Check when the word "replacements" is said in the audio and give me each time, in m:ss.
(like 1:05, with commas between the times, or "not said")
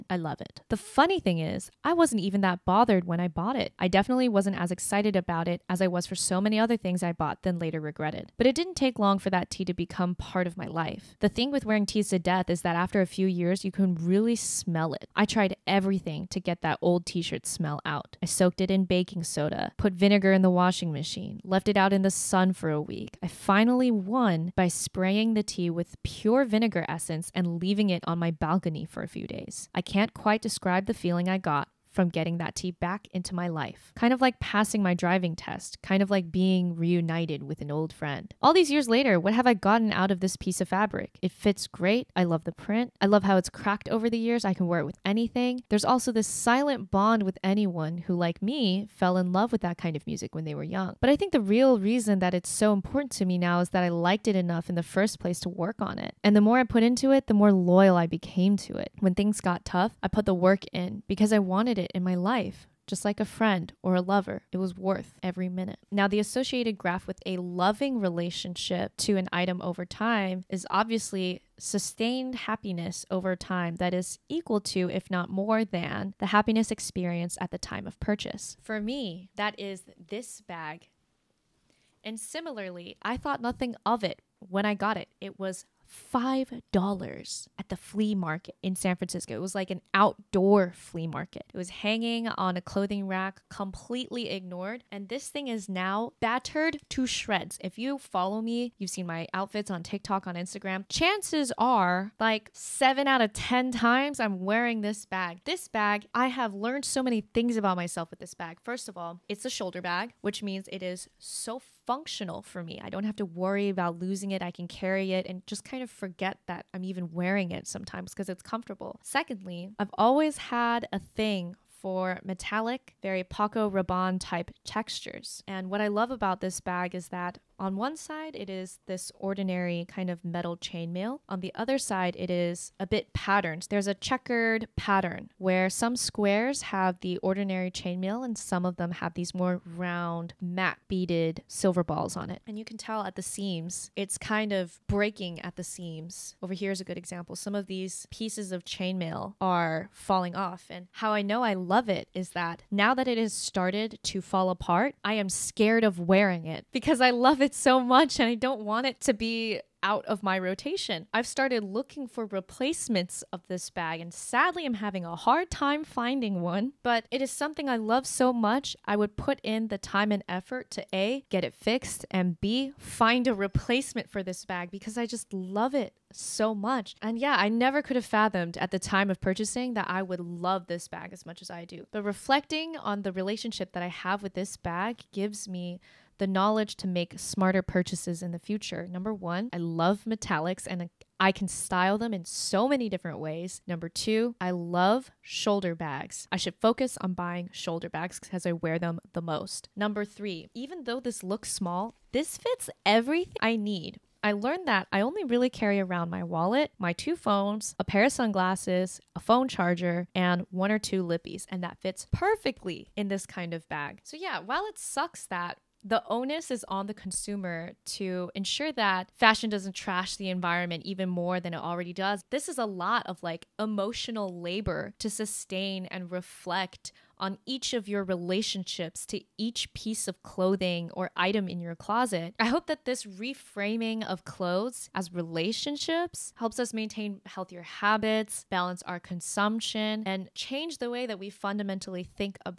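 2:42, 2:53.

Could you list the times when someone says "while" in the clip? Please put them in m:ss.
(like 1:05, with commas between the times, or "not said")
3:34.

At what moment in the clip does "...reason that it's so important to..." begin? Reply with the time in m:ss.
0:51.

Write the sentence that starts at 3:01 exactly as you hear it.
But reflecting on the relationship that I have with this bag gives me the knowledge to make smarter purchases in the future.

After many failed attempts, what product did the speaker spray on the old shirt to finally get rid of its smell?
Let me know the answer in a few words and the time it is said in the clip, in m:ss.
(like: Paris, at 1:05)
pure vinegar essence, at 0:26.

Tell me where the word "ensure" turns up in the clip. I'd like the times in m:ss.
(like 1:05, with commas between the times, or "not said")
3:38.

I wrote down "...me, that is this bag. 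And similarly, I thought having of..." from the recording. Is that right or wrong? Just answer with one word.
wrong.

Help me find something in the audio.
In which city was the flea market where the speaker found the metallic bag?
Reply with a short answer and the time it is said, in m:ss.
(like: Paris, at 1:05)
San Francisco, at 1:28.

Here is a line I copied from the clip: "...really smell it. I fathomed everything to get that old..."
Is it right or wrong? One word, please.
wrong.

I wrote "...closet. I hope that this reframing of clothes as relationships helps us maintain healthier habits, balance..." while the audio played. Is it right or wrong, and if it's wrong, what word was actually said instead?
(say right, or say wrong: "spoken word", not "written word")
right.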